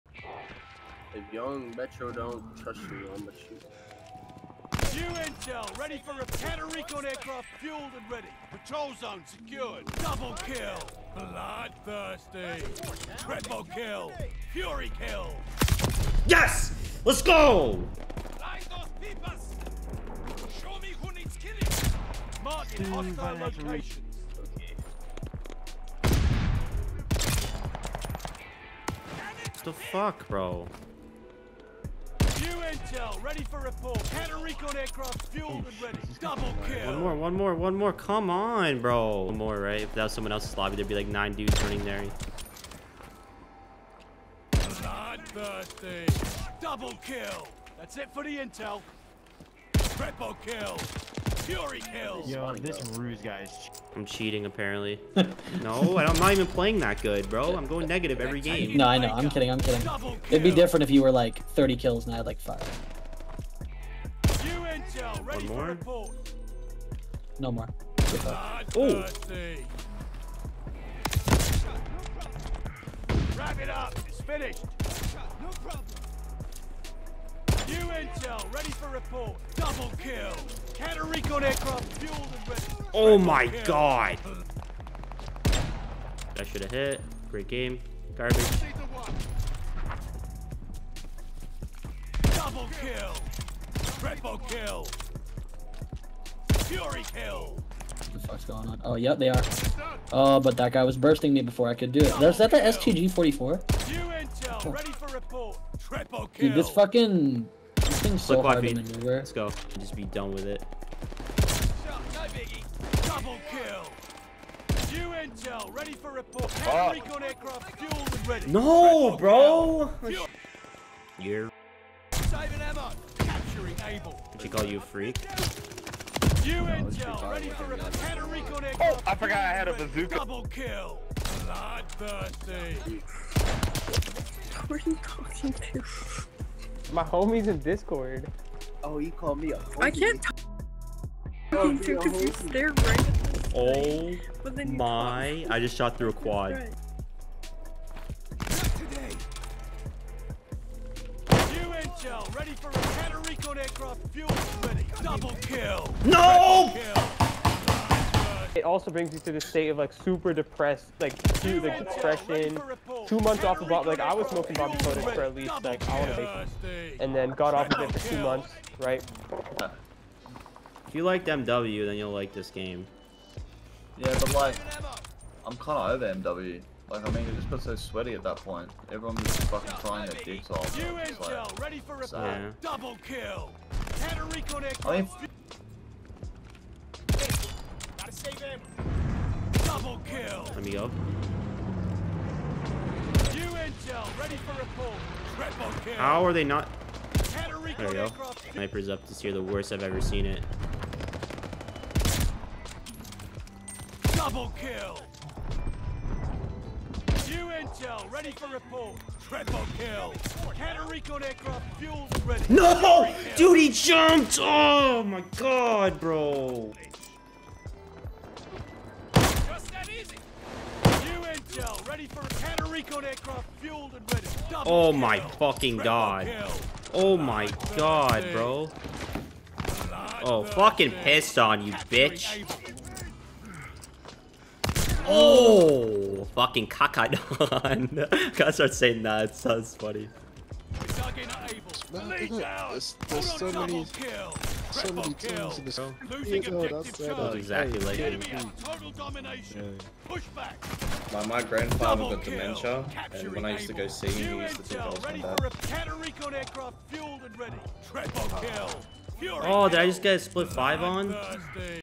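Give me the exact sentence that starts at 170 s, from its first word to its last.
If you liked MW, then you'll like this game.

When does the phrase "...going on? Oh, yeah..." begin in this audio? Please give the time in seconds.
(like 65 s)
98 s.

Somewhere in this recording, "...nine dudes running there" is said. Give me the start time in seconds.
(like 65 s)
41 s.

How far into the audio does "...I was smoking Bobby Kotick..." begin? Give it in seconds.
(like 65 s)
164 s.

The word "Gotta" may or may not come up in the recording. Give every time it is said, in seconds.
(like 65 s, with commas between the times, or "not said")
238 s.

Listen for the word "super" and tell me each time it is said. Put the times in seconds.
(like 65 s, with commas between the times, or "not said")
159 s.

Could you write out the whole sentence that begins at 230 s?
Oh, fucking pissed on you, bitch.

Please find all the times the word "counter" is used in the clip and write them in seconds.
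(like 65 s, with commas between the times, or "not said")
6 s, 34 s, 80 s.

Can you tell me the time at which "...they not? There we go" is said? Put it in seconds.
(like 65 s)
196 s.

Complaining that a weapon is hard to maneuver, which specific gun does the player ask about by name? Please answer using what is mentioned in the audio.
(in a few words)
STG-44.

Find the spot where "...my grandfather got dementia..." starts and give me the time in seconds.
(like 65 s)
251 s.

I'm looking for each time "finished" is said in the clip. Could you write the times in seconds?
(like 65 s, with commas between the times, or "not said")
74 s.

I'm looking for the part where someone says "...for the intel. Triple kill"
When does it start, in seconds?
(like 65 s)
48 s.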